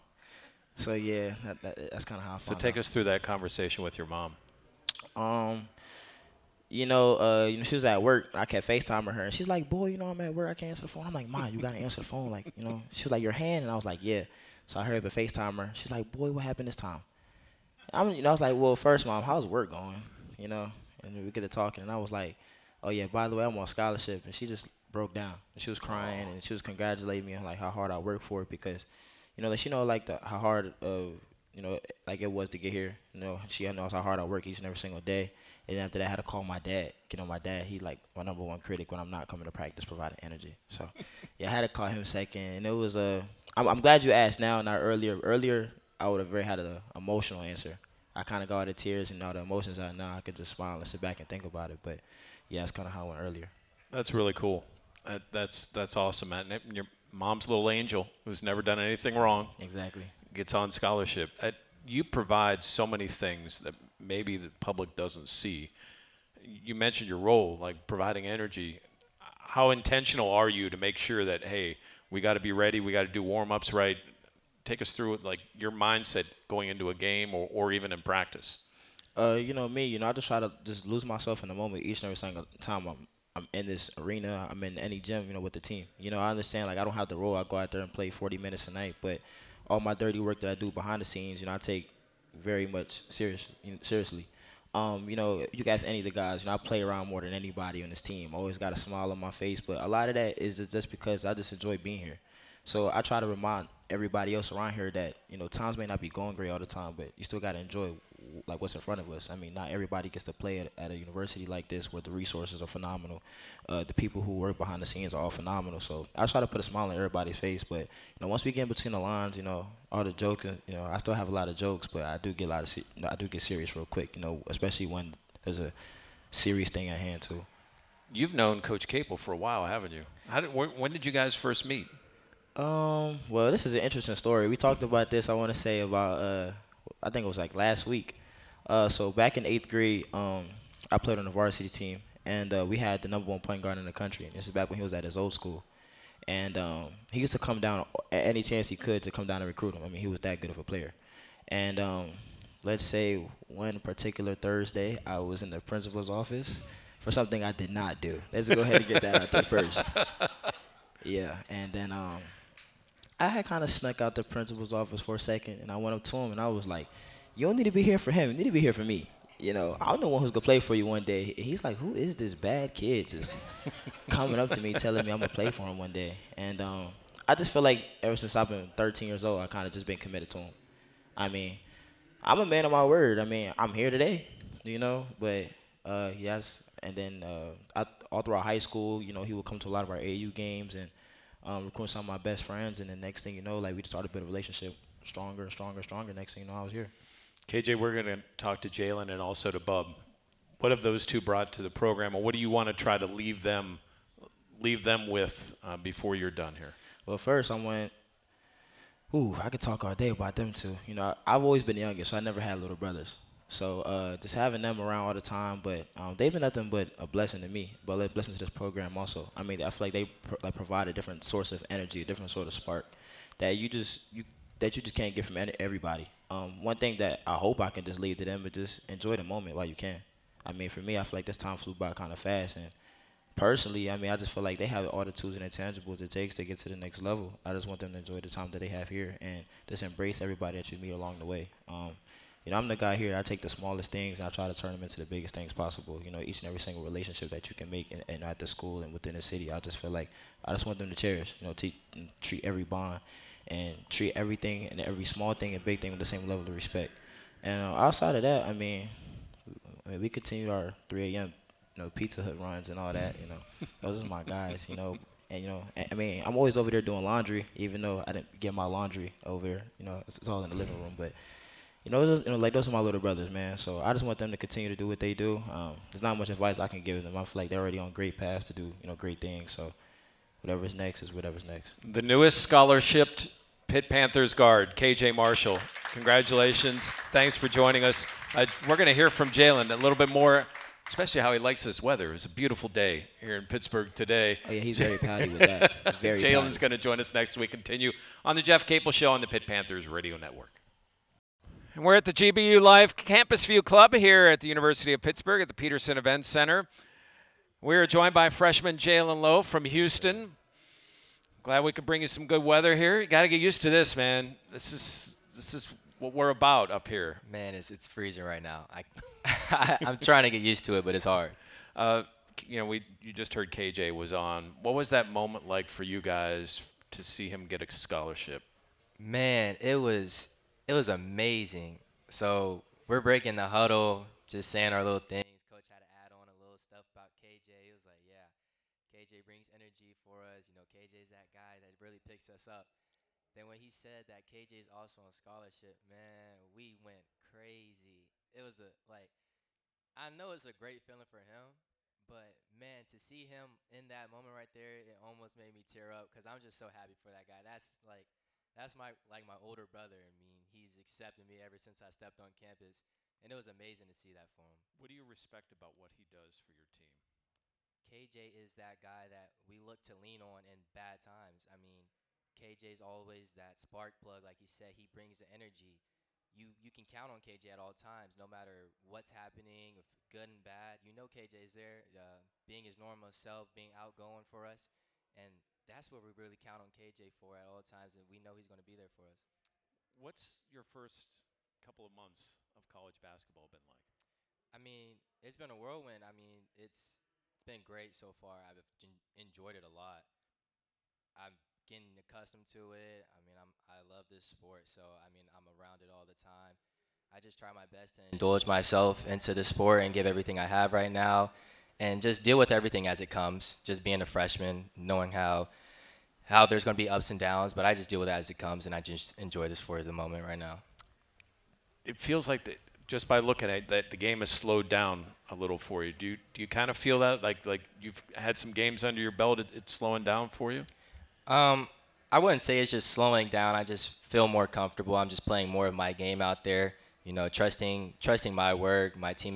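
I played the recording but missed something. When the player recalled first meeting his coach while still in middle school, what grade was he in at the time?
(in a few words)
8th grade.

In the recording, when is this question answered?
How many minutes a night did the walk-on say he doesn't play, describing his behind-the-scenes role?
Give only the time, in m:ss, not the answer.
1:28.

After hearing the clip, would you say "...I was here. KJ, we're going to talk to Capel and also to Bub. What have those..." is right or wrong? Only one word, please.
wrong.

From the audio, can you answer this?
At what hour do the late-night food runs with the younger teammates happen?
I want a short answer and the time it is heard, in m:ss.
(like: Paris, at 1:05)
3 a.m., at 4:20.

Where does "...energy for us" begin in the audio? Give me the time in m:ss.
5:39.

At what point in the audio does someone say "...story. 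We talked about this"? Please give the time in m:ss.
2:14.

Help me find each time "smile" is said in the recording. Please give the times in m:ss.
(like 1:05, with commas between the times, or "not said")
0:50, 1:38, 1:56.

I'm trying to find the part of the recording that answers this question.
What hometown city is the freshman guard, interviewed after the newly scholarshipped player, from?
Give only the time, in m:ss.
5:09.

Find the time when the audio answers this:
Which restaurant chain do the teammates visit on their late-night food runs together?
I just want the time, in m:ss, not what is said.
4:21.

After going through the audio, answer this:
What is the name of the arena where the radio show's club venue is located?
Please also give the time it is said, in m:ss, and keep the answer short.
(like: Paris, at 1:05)
Petersen Event Center, at 5:05.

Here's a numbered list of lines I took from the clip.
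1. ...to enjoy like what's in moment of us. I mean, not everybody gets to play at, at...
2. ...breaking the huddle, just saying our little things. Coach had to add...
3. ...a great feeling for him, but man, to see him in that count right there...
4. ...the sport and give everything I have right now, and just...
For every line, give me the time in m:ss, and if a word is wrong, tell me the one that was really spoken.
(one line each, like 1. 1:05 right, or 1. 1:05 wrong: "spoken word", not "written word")
1. 1:47 wrong: "front", not "moment"
2. 5:33 right
3. 5:50 wrong: "moment", not "count"
4. 6:49 right.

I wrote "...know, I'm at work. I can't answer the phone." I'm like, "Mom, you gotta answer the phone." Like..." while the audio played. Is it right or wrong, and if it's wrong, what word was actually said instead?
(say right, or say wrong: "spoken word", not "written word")
right.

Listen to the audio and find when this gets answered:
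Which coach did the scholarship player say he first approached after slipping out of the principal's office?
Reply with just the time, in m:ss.
2:08.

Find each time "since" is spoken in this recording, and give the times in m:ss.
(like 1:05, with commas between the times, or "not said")
2:58, 6:01.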